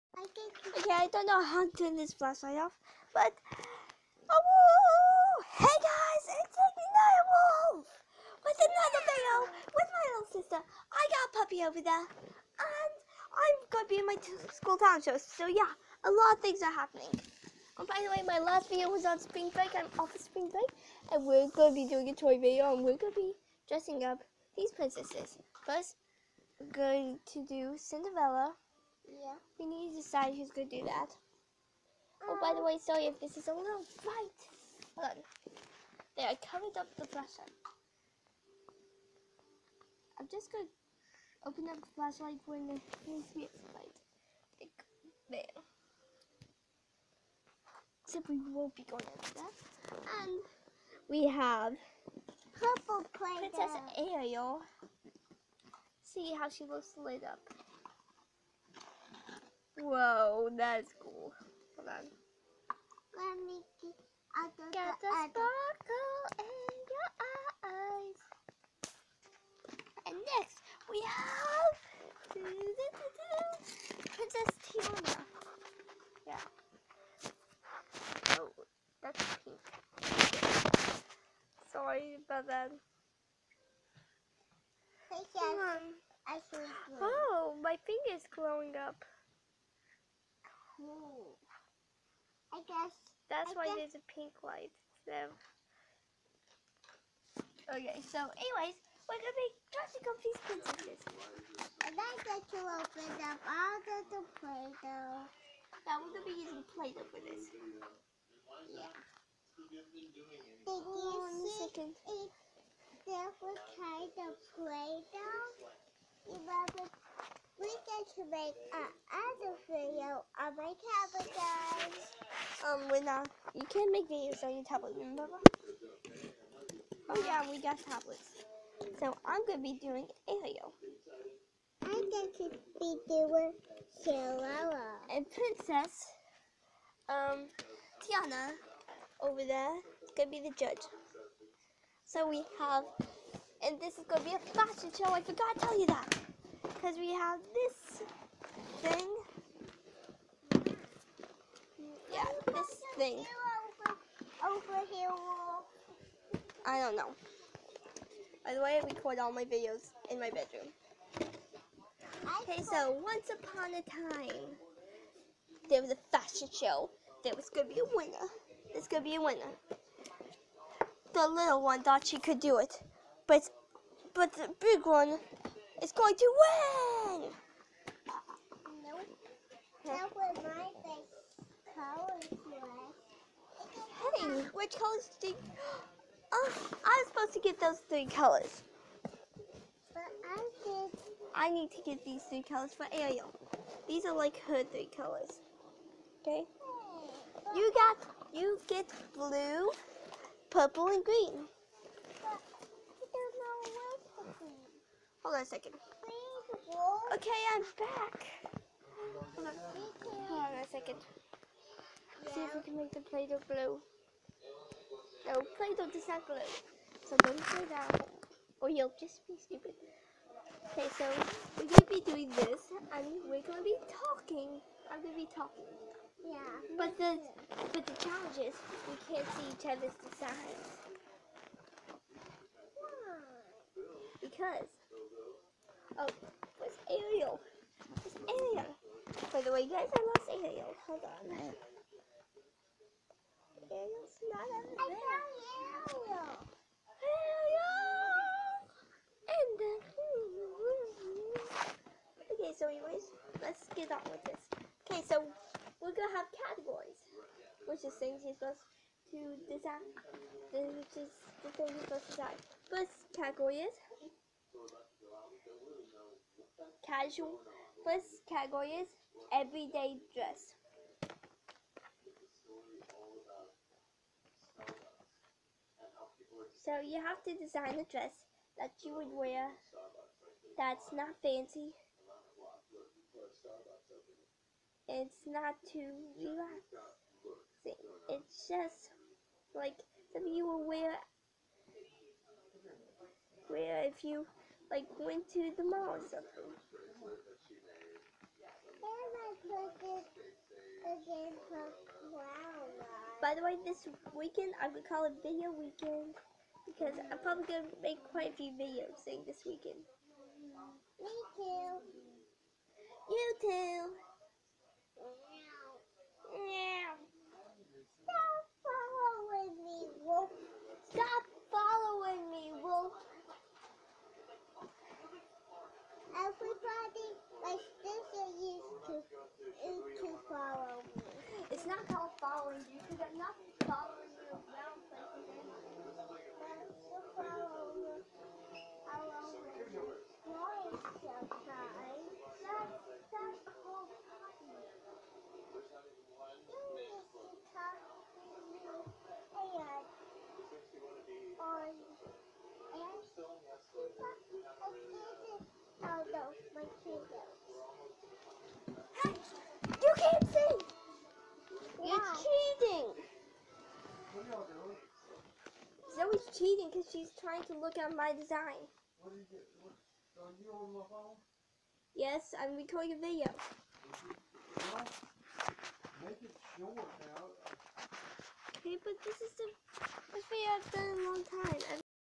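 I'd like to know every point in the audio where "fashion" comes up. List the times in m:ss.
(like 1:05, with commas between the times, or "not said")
2:24, 2:46.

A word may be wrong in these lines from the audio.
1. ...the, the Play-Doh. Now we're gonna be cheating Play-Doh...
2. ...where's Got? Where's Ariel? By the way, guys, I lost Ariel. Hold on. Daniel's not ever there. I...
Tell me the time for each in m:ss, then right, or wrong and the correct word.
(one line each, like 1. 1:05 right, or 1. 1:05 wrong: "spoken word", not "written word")
1. 1:43 wrong: "using", not "cheating"
2. 3:56 wrong: "Ariel", not "Got".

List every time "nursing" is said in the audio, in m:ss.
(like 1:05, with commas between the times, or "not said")
not said.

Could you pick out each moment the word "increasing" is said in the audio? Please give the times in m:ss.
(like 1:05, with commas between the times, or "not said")
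not said.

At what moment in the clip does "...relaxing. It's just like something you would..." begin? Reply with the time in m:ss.
4:46.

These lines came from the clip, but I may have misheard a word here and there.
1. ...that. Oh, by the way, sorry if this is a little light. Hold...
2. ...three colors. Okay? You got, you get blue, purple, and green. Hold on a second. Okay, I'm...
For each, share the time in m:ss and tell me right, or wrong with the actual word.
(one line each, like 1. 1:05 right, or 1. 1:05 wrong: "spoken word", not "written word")
1. 0:30 wrong: "bright", not "light"
2. 3:14 right.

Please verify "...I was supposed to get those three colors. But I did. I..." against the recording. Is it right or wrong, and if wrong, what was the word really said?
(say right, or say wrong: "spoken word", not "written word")
right.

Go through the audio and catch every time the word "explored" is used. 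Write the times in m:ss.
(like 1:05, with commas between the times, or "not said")
not said.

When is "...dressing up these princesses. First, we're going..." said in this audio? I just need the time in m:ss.
0:23.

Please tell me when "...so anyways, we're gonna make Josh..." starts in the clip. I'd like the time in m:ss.
1:38.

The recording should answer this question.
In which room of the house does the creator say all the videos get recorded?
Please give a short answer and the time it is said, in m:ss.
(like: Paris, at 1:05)
Bedroom, at 2:40.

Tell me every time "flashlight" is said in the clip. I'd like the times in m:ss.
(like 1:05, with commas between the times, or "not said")
0:02, 0:37, 0:41.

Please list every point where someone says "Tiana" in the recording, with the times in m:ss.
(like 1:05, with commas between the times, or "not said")
1:14, 2:18.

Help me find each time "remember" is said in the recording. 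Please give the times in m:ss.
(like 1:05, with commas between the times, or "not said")
1:56, 2:04.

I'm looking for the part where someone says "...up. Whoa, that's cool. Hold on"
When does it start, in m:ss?
0:57.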